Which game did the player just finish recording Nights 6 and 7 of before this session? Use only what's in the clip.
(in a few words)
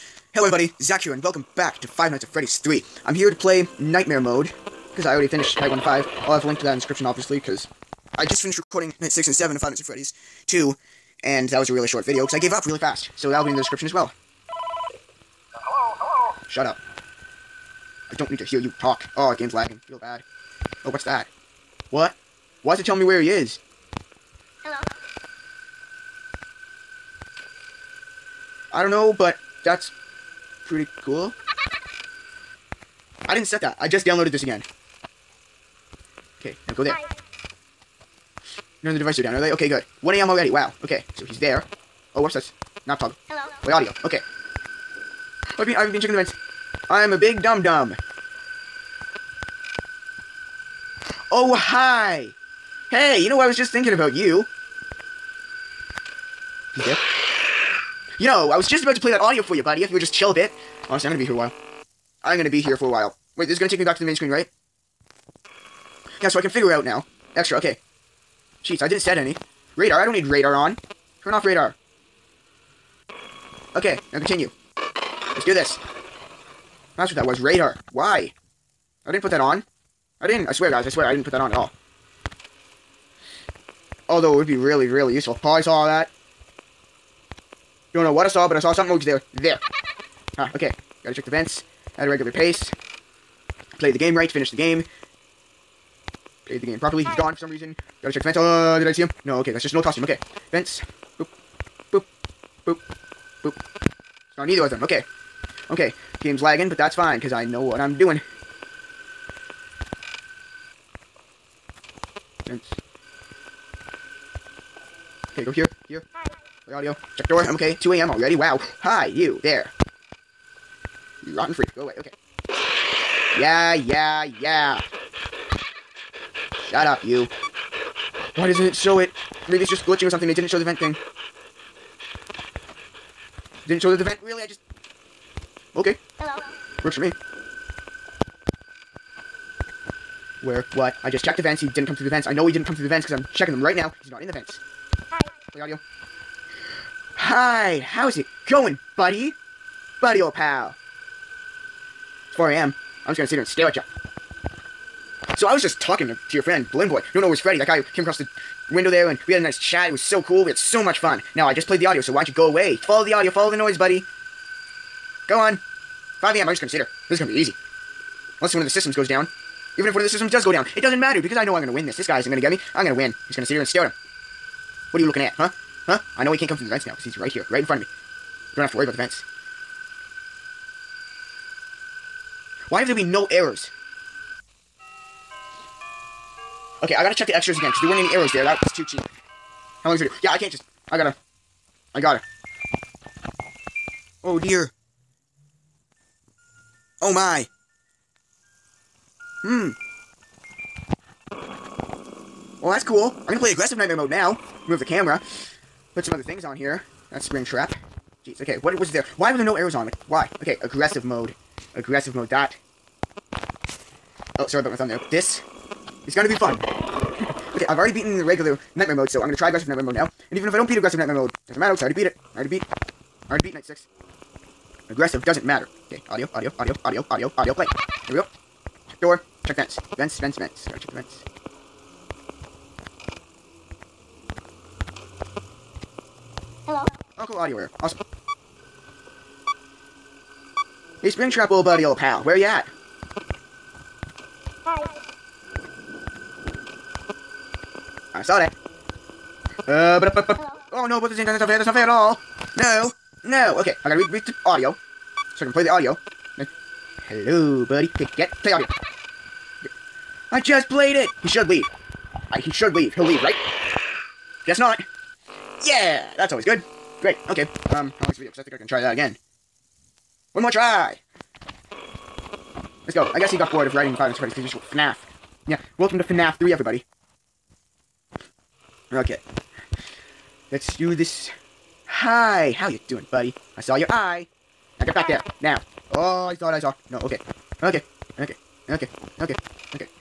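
Five Nights at Freddy's 2.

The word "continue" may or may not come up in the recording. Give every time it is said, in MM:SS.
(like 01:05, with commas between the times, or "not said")
01:14.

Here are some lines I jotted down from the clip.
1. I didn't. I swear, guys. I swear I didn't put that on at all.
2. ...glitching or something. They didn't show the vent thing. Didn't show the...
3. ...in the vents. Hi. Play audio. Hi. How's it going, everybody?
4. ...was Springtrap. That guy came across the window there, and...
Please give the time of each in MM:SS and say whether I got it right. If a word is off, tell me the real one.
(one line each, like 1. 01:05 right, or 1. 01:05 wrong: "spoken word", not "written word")
1. 01:20 right
2. 02:09 right
3. 02:24 wrong: "buddy", not "everybody"
4. 02:37 wrong: "Freddy", not "Springtrap".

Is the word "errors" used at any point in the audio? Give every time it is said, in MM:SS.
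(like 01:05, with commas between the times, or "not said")
03:03, 03:57.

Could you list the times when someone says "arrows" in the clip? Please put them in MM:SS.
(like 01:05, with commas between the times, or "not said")
03:08, 03:29.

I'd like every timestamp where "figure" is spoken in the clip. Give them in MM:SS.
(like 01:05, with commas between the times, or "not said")
01:06.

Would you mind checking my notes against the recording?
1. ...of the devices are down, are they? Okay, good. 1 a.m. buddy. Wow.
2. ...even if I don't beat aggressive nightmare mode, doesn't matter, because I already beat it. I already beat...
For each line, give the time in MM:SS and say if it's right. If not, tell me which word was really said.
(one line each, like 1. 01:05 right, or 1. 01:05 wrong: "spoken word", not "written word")
1. 00:38 wrong: "already", not "buddy"
2. 03:40 right.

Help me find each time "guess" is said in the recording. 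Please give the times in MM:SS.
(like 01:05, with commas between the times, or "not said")
04:24, 04:33.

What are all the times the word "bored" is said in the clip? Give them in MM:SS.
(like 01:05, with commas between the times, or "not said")
04:33.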